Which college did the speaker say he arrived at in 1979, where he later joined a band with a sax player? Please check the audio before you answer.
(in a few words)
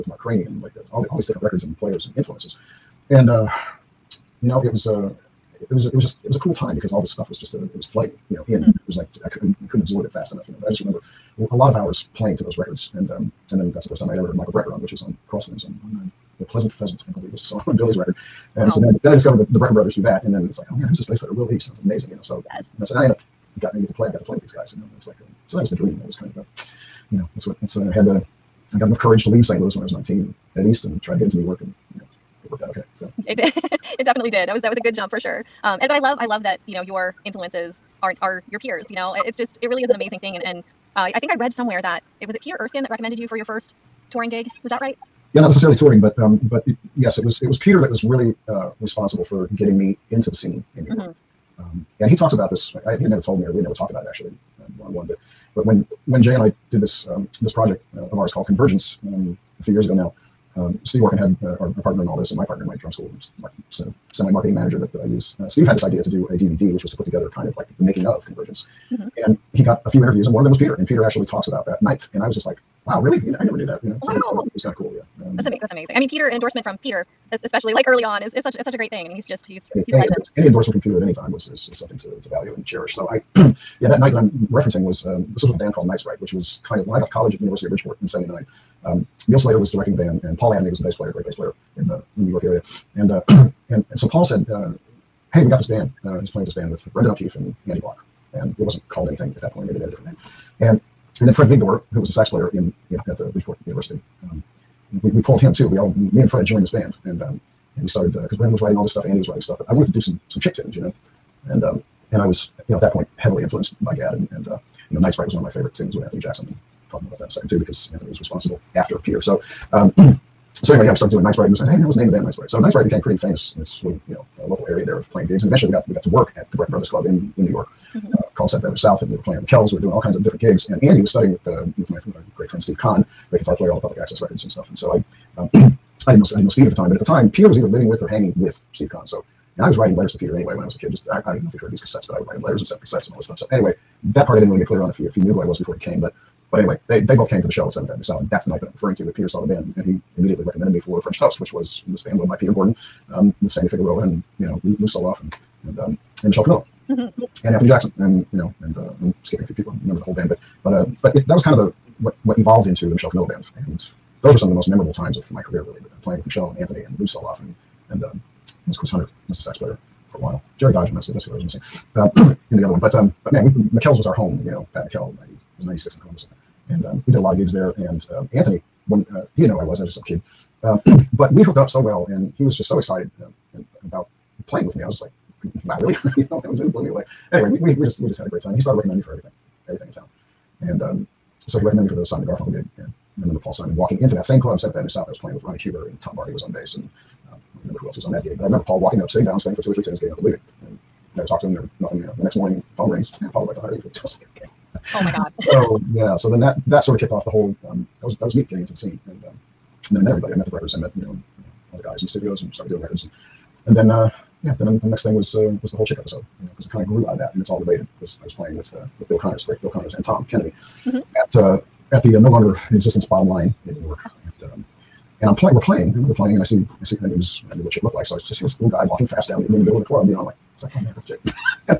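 University of Bridgeport.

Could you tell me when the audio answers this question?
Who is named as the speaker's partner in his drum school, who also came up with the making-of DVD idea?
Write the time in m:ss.
1:00.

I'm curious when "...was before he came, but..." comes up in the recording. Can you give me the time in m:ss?
2:25.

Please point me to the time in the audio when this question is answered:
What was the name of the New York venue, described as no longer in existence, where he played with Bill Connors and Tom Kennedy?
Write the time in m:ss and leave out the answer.
3:43.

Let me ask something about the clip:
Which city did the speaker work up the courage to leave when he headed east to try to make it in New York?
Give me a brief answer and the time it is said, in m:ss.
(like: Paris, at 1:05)
St. Louis, at 0:29.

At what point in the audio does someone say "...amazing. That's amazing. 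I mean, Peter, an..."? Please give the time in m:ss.
1:15.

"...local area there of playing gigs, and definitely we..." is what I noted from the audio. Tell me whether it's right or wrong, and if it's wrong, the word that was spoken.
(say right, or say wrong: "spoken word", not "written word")
wrong: "eventually", not "definitely".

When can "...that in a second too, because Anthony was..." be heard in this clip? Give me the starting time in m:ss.
1:57.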